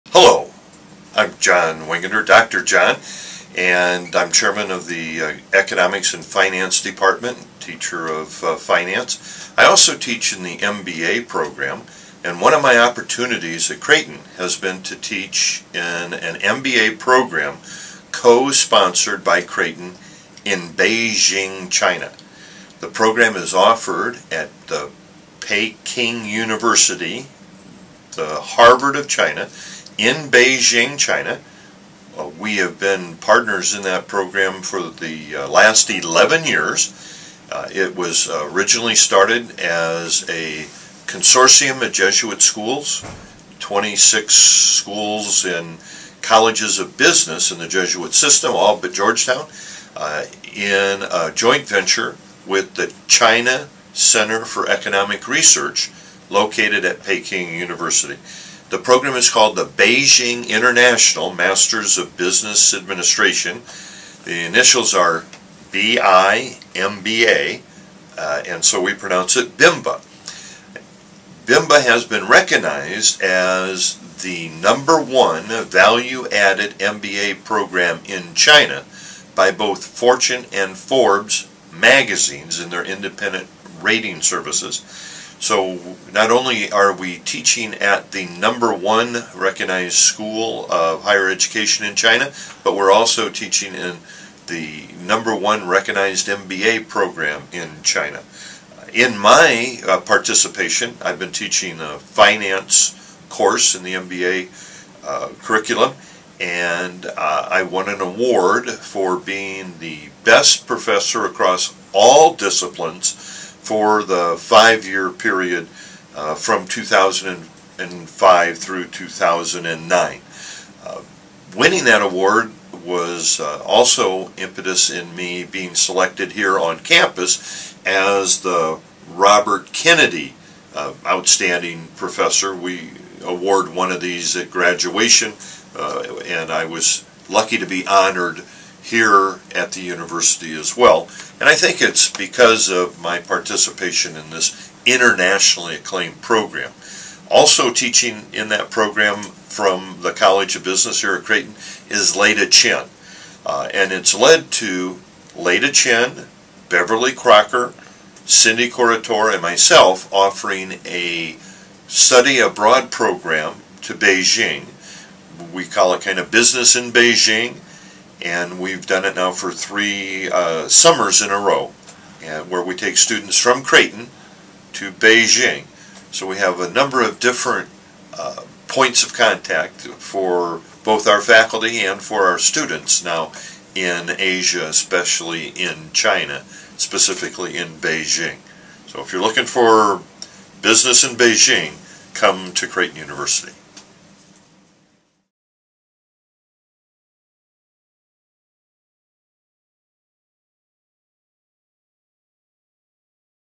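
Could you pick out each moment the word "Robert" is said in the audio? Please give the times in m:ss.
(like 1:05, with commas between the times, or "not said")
2:09.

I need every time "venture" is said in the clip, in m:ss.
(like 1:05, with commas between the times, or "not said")
0:51.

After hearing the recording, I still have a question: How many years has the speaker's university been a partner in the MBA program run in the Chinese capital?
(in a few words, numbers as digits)
11.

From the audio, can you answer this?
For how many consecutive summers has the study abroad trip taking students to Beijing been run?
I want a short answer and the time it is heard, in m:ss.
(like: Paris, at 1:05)
3, at 2:49.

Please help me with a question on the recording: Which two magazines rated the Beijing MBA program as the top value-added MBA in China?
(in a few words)
Fortune and Forbes.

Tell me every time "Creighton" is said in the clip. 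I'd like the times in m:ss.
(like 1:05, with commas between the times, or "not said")
0:13, 0:19, 2:31, 2:53, 3:12.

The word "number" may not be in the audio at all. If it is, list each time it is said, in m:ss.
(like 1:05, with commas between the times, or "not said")
1:14, 1:28, 1:35, 2:56.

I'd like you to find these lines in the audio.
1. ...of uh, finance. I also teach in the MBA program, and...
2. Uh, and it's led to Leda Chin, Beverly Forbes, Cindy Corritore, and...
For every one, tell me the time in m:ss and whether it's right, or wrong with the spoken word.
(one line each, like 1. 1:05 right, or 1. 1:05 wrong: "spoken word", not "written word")
1. 0:08 right
2. 2:33 wrong: "Kracher", not "Forbes".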